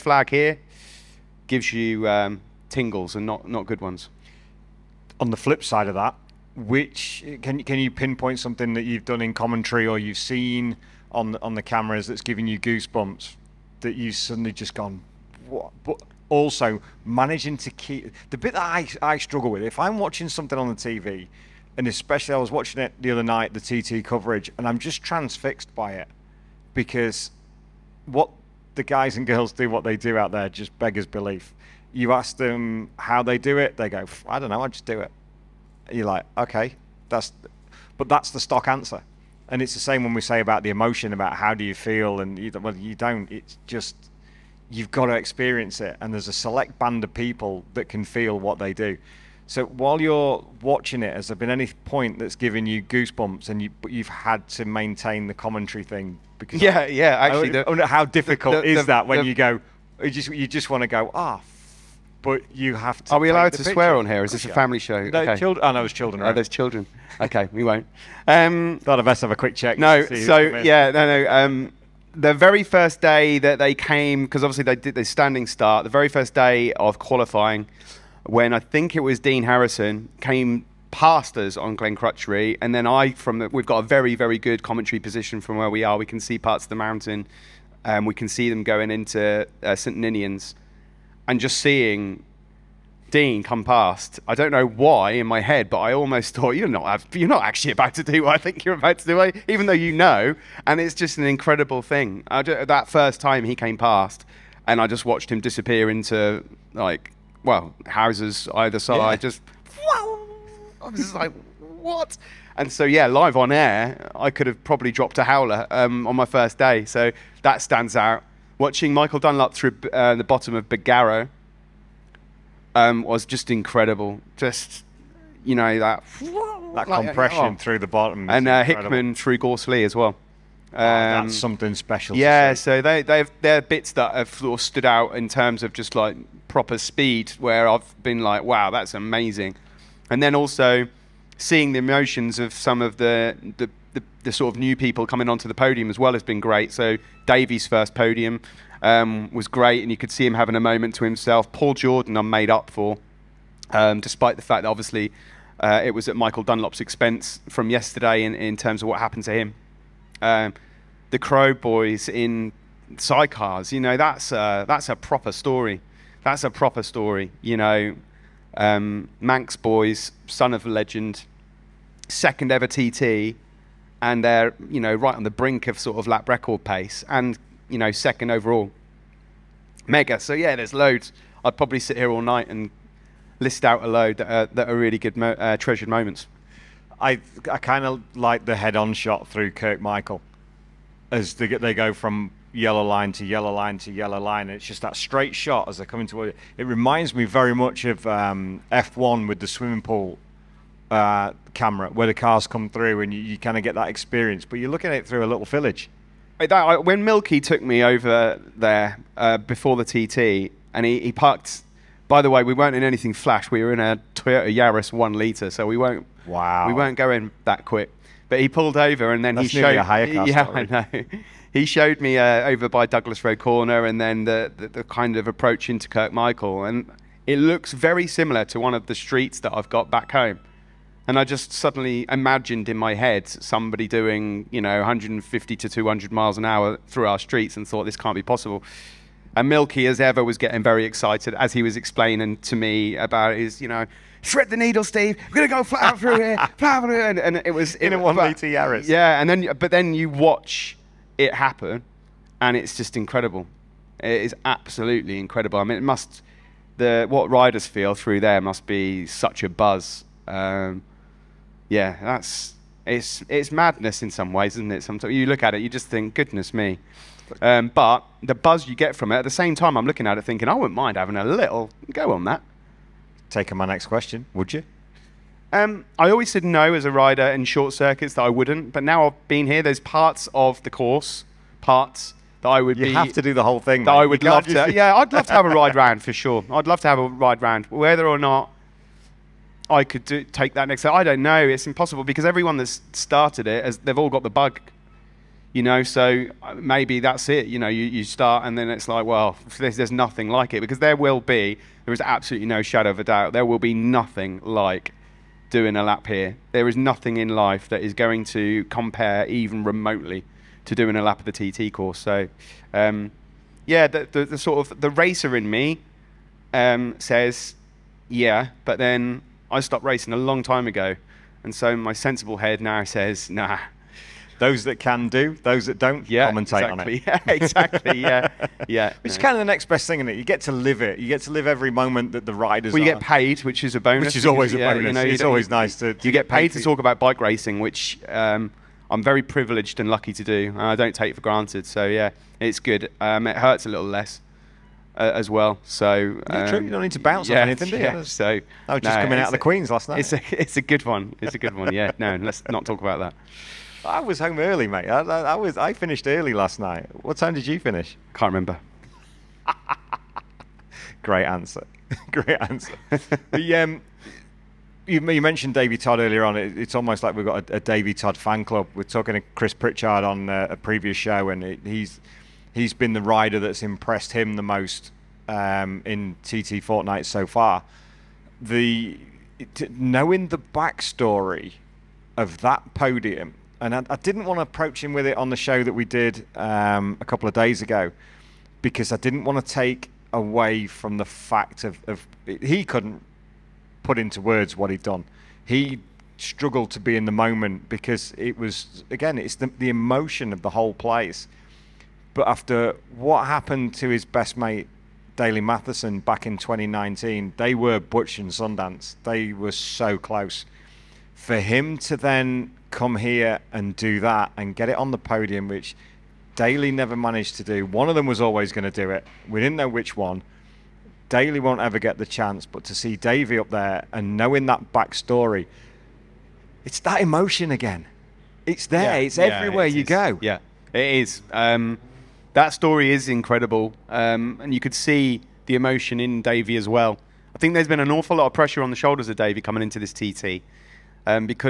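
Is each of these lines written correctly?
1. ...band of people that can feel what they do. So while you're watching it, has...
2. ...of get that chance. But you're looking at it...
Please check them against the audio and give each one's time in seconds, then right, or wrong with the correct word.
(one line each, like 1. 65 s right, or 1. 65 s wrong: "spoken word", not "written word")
1. 46 s right
2. 203 s wrong: "experience", not "chance".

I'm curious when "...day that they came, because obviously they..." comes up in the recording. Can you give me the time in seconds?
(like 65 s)
73 s.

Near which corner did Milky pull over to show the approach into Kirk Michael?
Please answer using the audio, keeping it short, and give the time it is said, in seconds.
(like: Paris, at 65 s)
Douglas Road corner, at 222 s.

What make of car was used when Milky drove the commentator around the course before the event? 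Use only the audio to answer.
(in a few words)
Toyota Yaris.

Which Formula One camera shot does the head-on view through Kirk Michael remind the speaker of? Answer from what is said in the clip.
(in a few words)
swimming pool.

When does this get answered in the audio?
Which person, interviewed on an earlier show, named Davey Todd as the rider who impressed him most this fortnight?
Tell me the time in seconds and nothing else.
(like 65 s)
369 s.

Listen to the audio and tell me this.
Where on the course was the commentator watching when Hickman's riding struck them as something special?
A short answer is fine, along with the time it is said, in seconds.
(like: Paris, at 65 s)
Gorse Lea, at 129 s.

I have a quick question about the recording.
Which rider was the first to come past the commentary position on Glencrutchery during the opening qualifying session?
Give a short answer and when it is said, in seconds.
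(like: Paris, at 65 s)
Dean Harrison, at 79 s.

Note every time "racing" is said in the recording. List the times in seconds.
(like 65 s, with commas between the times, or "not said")
319 s, 337 s.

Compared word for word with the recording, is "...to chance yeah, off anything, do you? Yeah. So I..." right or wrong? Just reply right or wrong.
wrong.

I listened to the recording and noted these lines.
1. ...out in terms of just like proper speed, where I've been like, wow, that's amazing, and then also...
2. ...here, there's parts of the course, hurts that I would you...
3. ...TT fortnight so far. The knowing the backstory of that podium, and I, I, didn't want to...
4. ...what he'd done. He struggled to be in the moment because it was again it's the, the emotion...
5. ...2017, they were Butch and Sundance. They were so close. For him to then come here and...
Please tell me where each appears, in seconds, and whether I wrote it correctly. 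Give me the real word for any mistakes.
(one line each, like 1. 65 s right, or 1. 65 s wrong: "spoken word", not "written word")
1. 134 s right
2. 279 s wrong: "parts", not "hurts"
3. 376 s right
4. 394 s right
5. 406 s wrong: "2019", not "2017".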